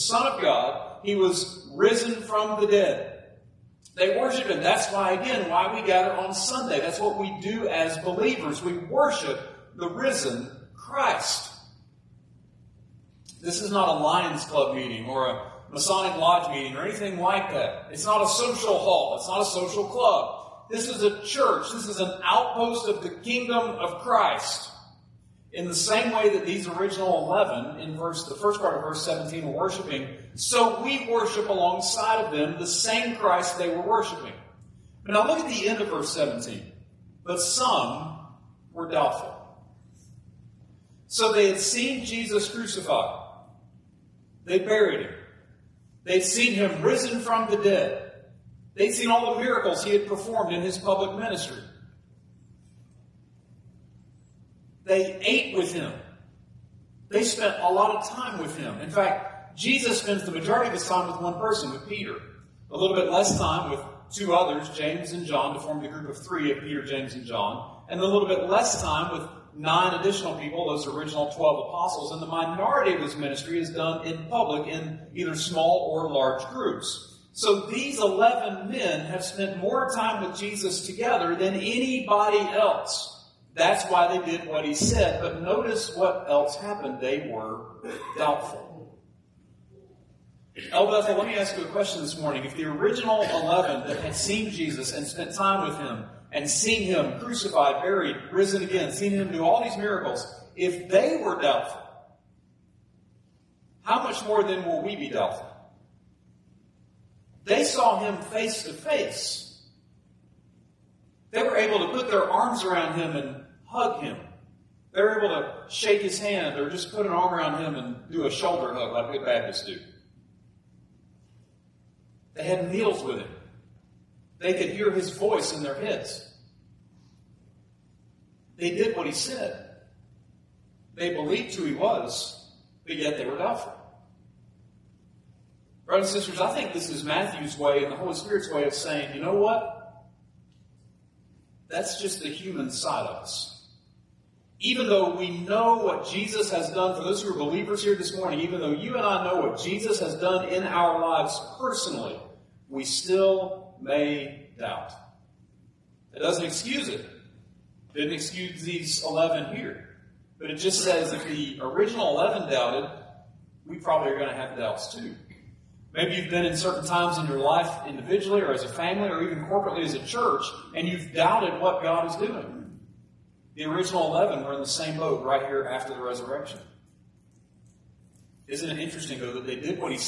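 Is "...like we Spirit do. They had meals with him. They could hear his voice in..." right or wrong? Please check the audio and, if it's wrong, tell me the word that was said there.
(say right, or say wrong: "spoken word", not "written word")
wrong: "Baptists", not "Spirit".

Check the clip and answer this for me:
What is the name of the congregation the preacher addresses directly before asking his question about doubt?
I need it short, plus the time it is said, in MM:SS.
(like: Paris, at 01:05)
Bethel, at 01:30.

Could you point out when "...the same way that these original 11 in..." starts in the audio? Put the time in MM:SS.
00:25.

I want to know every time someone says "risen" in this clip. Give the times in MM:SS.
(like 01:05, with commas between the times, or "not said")
00:01, 00:09, 00:46, 01:38.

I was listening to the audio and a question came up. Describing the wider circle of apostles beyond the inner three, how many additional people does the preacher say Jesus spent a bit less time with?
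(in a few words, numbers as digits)
9.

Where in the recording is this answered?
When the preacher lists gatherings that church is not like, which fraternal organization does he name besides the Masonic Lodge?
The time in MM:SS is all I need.
00:13.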